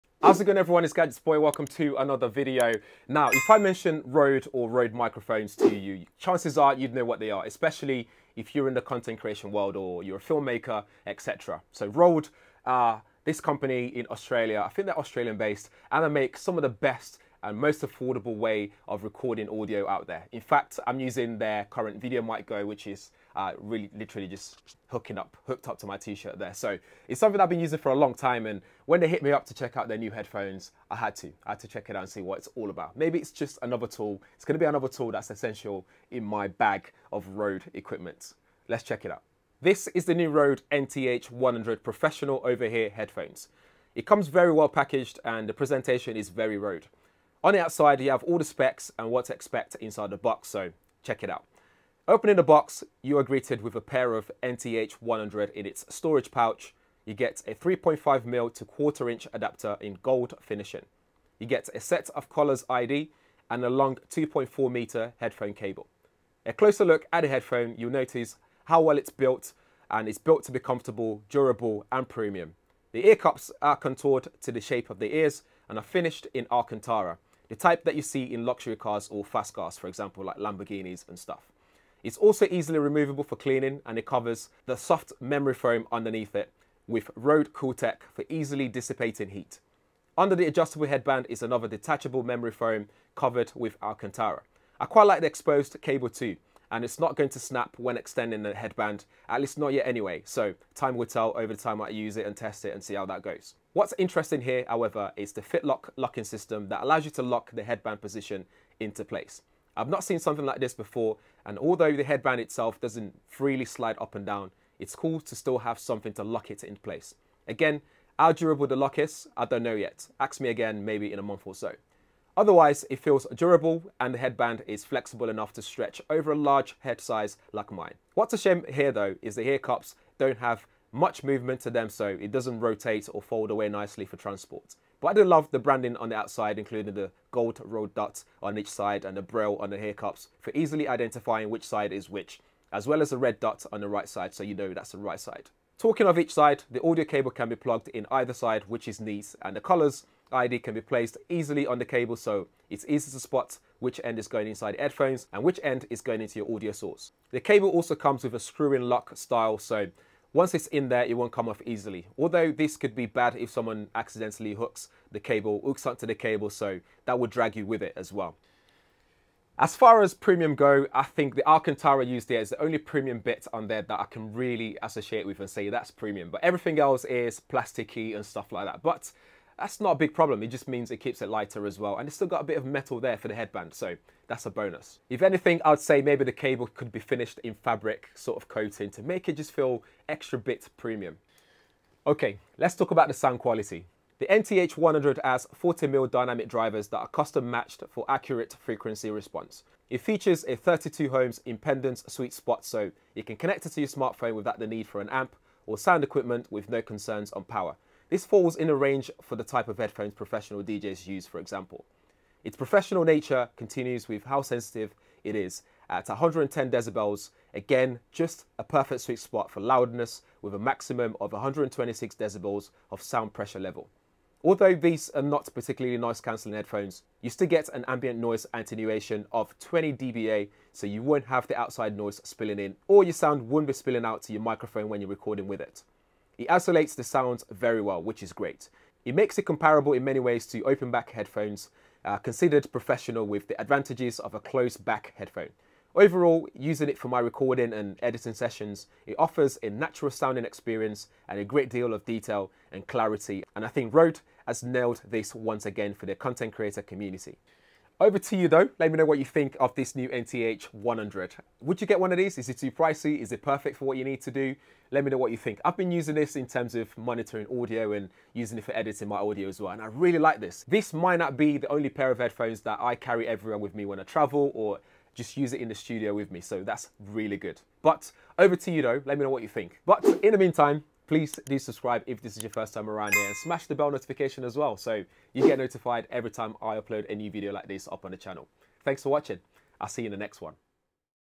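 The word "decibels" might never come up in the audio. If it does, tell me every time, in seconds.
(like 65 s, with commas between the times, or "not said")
216 s, 222 s.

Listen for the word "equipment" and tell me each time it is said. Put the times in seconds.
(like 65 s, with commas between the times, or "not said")
37 s, 206 s.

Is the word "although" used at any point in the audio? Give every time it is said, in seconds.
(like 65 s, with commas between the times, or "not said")
111 s, 162 s, 224 s.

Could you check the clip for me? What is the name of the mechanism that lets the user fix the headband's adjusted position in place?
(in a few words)
FitLok.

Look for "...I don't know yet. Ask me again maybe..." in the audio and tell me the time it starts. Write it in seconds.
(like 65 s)
119 s.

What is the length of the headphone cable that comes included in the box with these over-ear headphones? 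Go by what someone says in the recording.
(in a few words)
2.4 meters.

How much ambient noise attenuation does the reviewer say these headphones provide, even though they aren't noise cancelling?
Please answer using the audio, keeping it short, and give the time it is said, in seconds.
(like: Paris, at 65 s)
20 dBA, at 229 s.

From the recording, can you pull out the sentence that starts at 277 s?
But over to you though, let me know what you think.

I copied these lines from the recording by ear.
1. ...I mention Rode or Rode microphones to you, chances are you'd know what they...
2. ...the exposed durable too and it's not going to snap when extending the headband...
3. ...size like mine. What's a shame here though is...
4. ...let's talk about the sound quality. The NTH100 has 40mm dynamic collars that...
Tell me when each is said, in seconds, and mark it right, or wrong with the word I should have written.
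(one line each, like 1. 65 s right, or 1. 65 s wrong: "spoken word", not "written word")
1. 3 s right
2. 95 s wrong: "cable", not "durable"
3. 127 s right
4. 192 s wrong: "drivers", not "collars".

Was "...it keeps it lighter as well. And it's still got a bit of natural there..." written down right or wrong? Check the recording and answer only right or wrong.
wrong.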